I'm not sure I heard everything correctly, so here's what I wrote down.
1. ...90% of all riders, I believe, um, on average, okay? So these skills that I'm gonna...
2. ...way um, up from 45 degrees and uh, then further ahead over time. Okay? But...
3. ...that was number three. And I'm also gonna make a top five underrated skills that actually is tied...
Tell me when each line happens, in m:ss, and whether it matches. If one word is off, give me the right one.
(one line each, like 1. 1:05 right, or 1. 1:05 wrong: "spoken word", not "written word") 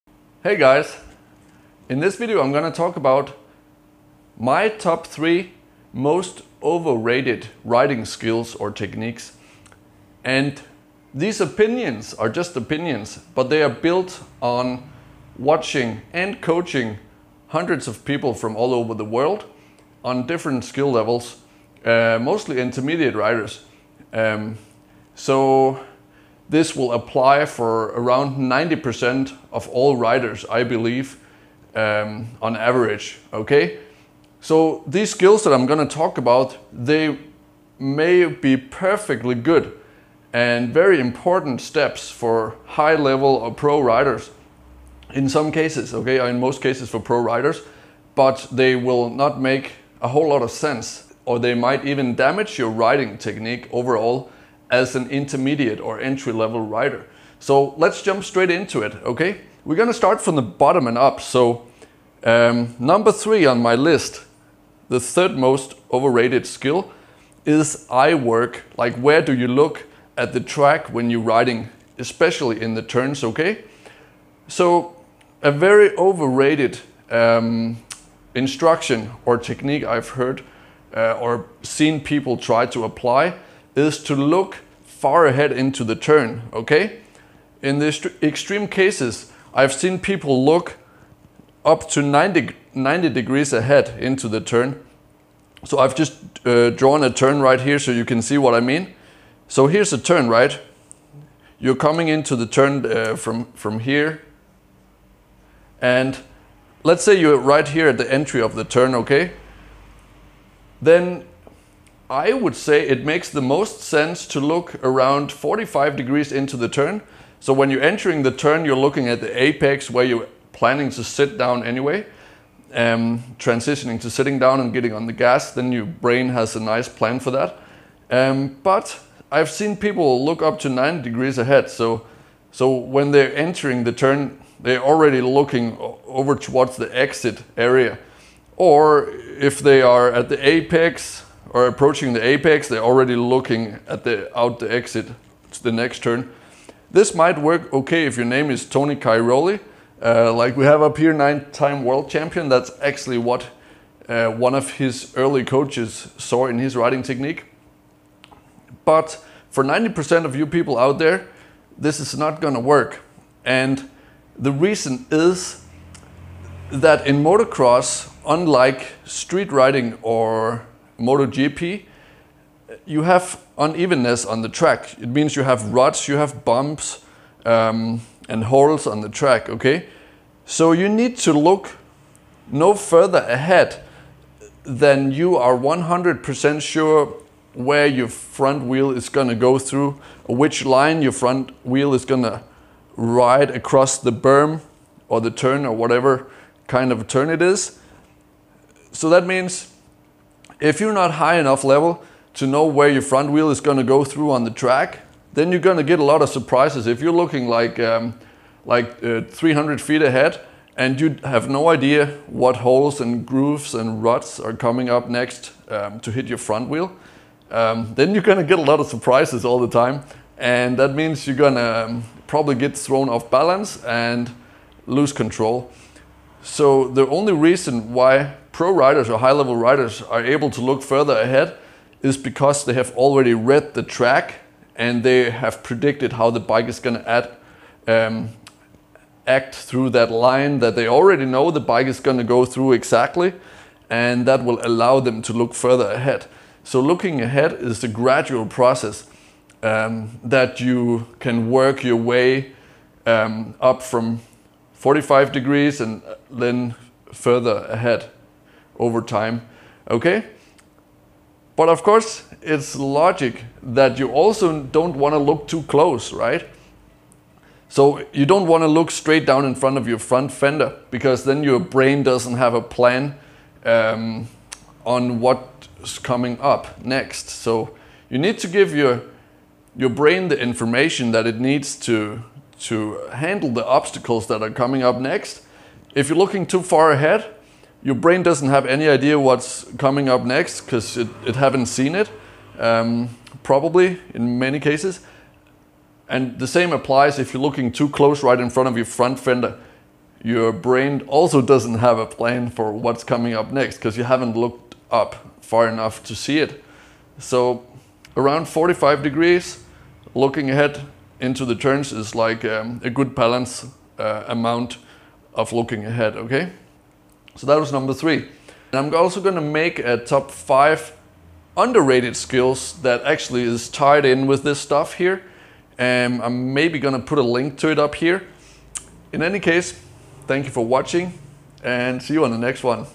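1. 0:28 right
2. 4:11 right
3. 5:17 right.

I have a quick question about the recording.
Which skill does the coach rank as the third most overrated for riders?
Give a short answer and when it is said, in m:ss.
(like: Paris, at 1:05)
Eye work, at 1:07.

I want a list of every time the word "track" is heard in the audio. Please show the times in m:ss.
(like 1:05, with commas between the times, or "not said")
1:10, 2:54, 2:59, 3:24, 3:53.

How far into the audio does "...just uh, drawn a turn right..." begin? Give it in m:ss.
1:35.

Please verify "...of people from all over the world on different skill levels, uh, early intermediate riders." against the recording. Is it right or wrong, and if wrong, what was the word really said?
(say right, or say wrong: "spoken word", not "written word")
wrong: "mostly", not "early".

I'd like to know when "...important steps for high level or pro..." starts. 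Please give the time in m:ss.
0:40.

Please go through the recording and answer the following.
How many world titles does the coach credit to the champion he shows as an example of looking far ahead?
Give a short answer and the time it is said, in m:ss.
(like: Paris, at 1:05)
9, at 2:31.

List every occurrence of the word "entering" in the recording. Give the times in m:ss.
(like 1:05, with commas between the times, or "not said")
1:57, 2:13.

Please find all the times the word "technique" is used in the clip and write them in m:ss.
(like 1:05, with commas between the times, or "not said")
0:08, 0:53, 1:19, 2:37.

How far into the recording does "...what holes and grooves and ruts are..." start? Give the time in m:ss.
3:32.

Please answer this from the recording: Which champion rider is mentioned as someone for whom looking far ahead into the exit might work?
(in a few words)
Tony Cairoli.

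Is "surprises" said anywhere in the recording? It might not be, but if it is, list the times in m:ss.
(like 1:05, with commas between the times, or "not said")
3:26, 3:38.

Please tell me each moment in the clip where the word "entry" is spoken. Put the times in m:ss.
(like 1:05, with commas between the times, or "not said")
0:55, 1:48.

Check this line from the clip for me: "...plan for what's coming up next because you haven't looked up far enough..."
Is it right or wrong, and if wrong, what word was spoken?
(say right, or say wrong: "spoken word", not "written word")
right.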